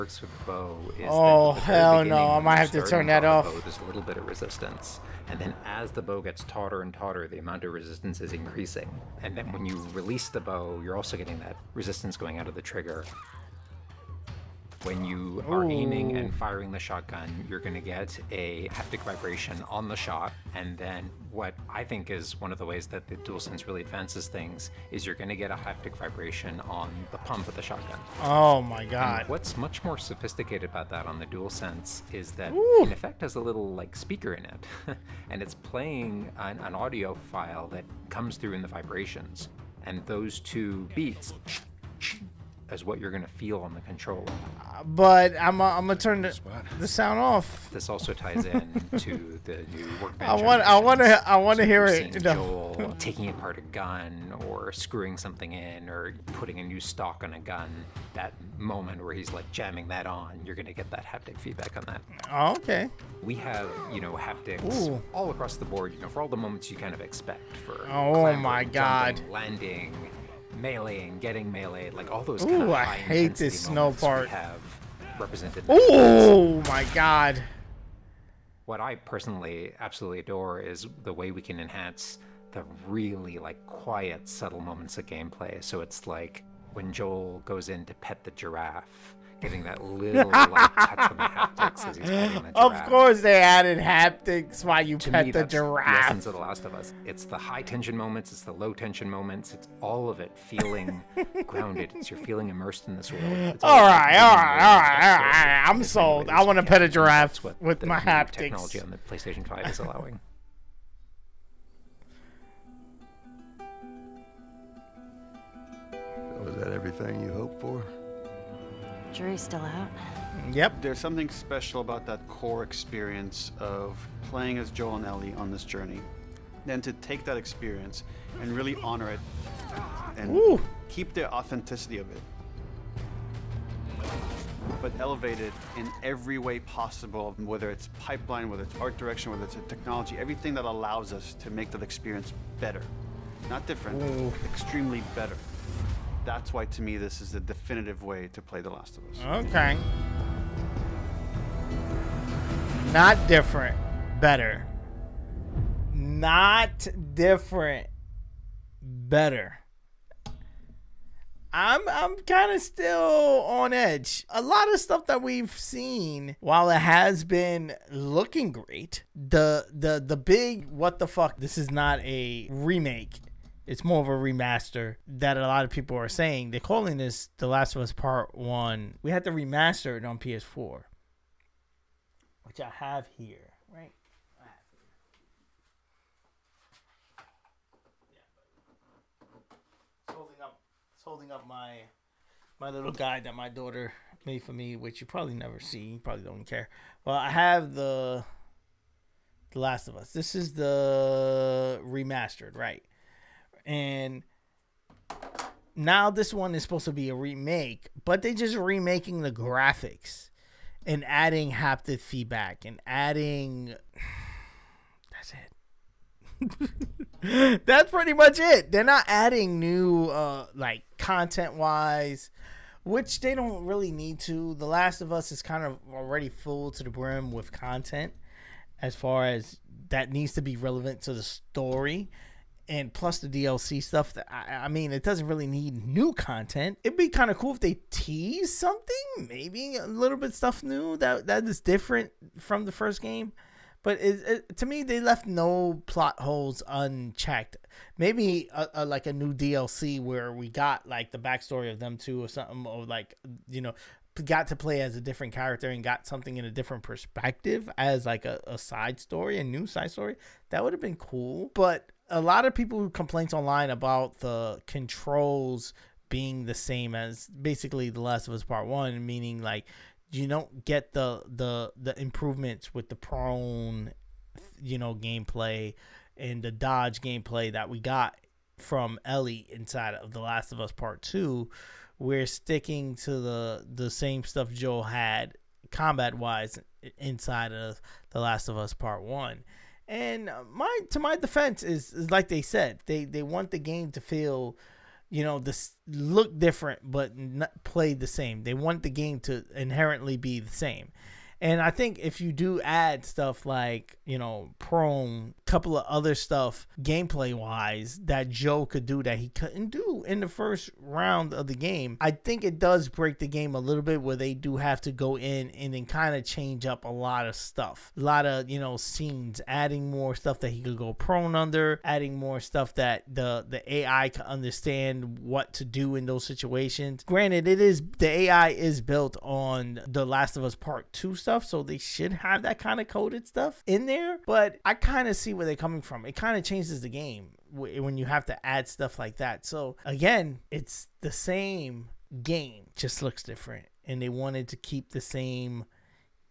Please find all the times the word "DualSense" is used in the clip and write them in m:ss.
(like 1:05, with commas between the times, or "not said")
0:23, 0:31.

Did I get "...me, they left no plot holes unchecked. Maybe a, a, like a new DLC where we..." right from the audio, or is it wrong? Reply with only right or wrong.
right.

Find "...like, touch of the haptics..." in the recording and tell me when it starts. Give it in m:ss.
1:30.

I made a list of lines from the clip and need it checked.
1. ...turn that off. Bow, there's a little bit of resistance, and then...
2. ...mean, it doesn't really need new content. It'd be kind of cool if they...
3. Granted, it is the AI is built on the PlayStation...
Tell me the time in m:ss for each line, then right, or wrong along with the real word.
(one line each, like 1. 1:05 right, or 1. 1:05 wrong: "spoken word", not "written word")
1. 0:02 right
2. 3:54 right
3. 5:27 wrong: "Last", not "PlayStation".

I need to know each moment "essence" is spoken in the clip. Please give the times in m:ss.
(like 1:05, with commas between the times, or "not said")
1:36.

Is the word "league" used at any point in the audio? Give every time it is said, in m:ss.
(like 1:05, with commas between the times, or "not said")
not said.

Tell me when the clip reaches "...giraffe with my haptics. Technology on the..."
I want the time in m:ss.
1:46.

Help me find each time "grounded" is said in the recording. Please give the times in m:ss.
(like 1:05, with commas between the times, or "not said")
1:41.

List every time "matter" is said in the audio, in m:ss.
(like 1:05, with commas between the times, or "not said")
not said.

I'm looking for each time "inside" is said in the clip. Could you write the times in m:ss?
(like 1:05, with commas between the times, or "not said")
4:39, 4:46.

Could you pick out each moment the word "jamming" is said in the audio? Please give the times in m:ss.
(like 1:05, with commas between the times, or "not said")
0:59.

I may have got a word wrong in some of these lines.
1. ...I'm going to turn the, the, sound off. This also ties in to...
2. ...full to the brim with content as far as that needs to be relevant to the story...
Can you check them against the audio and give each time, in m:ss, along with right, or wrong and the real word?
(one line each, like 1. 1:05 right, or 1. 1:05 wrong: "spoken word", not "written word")
1. 0:45 right
2. 3:46 right.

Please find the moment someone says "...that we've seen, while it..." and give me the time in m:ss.
2:45.